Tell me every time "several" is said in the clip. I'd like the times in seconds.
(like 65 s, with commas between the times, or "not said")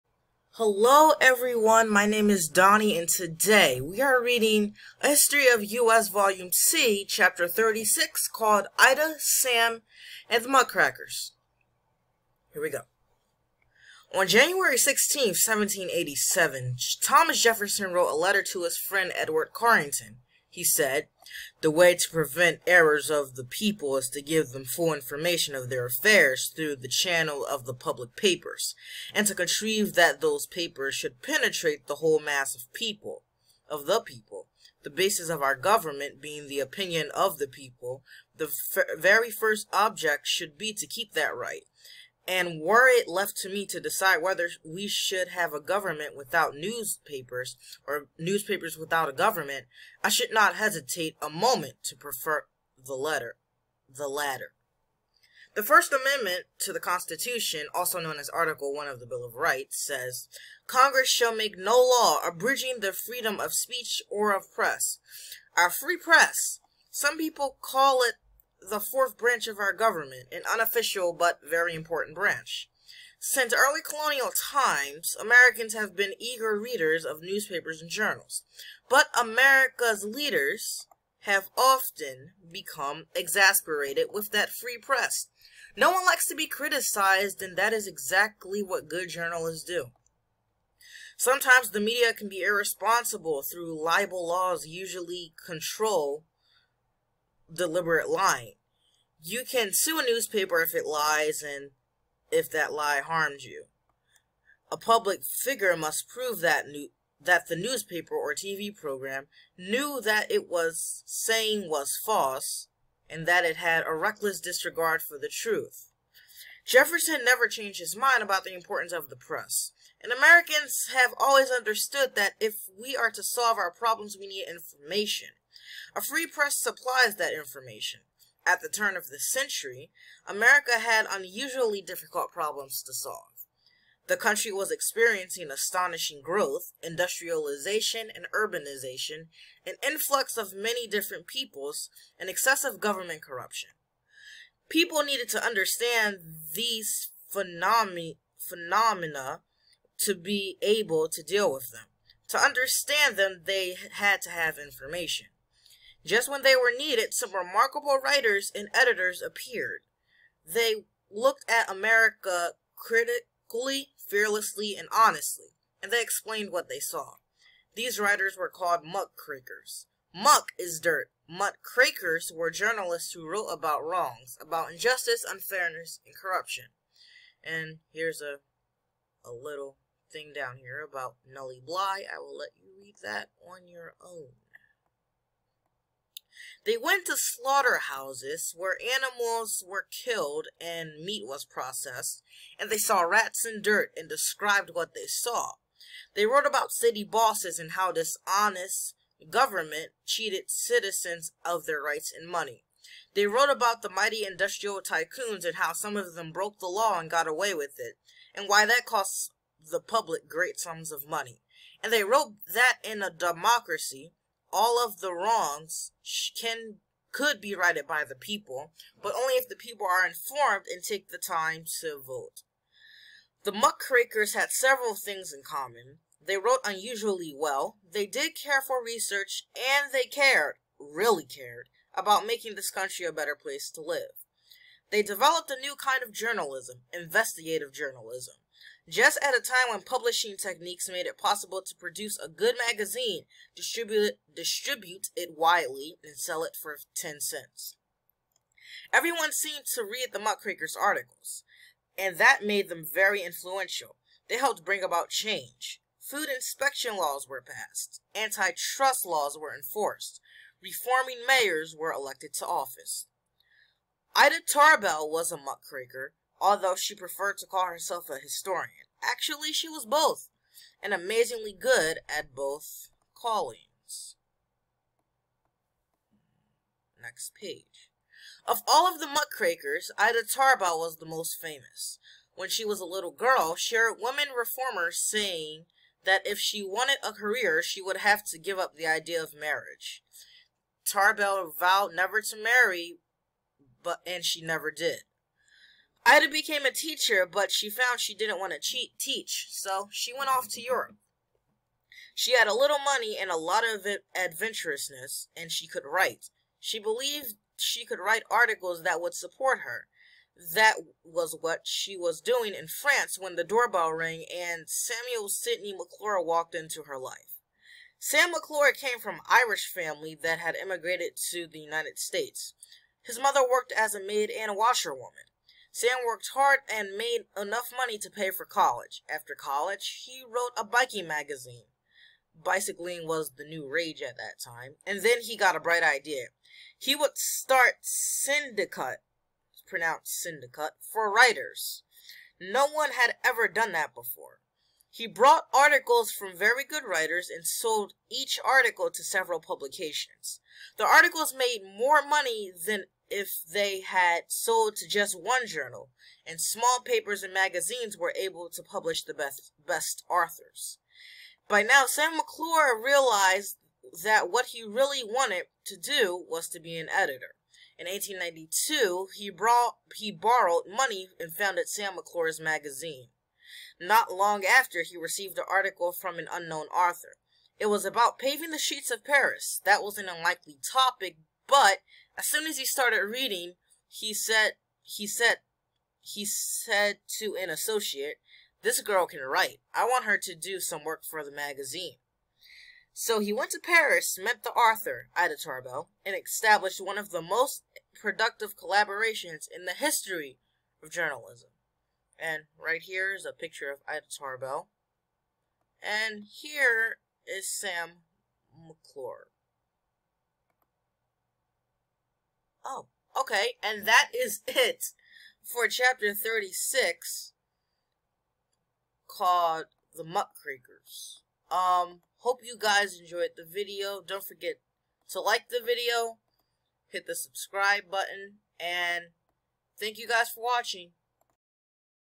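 224 s, 349 s.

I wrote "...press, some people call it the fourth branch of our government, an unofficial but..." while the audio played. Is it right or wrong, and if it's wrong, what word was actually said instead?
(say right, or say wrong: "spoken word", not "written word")
right.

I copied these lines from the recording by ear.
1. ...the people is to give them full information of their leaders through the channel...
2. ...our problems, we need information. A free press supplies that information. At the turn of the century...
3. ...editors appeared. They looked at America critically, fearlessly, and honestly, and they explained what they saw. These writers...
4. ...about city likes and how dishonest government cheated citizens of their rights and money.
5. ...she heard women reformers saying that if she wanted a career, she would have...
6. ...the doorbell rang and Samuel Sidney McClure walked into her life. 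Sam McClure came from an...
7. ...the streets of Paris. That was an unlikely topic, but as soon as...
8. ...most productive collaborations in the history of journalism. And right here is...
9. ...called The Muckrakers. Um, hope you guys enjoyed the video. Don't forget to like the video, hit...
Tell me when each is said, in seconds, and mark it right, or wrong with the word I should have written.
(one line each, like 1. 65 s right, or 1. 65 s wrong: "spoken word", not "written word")
1. 23 s wrong: "affairs", not "leaders"
2. 123 s right
3. 158 s right
4. 196 s wrong: "bosses", not "likes"
5. 283 s right
6. 313 s right
7. 378 s right
8. 397 s right
9. 419 s right.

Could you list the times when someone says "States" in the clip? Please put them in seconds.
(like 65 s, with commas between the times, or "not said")
321 s.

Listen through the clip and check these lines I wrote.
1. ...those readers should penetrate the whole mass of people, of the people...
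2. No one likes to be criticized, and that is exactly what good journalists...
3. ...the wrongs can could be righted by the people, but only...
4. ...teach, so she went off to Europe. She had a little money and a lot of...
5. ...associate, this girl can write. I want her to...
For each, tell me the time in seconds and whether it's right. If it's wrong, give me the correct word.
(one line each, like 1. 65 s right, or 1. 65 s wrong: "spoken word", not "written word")
1. 30 s wrong: "papers", not "readers"
2. 85 s right
3. 214 s right
4. 298 s right
5. 387 s right.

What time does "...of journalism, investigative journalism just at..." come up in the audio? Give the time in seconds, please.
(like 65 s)
236 s.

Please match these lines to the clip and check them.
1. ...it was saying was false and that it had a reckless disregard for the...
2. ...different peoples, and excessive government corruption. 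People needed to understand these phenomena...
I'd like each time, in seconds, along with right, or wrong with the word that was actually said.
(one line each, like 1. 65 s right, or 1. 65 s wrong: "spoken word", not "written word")
1. 110 s right
2. 140 s right.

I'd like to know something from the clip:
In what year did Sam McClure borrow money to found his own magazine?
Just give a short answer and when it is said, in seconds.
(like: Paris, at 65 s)
1892, at 367 s.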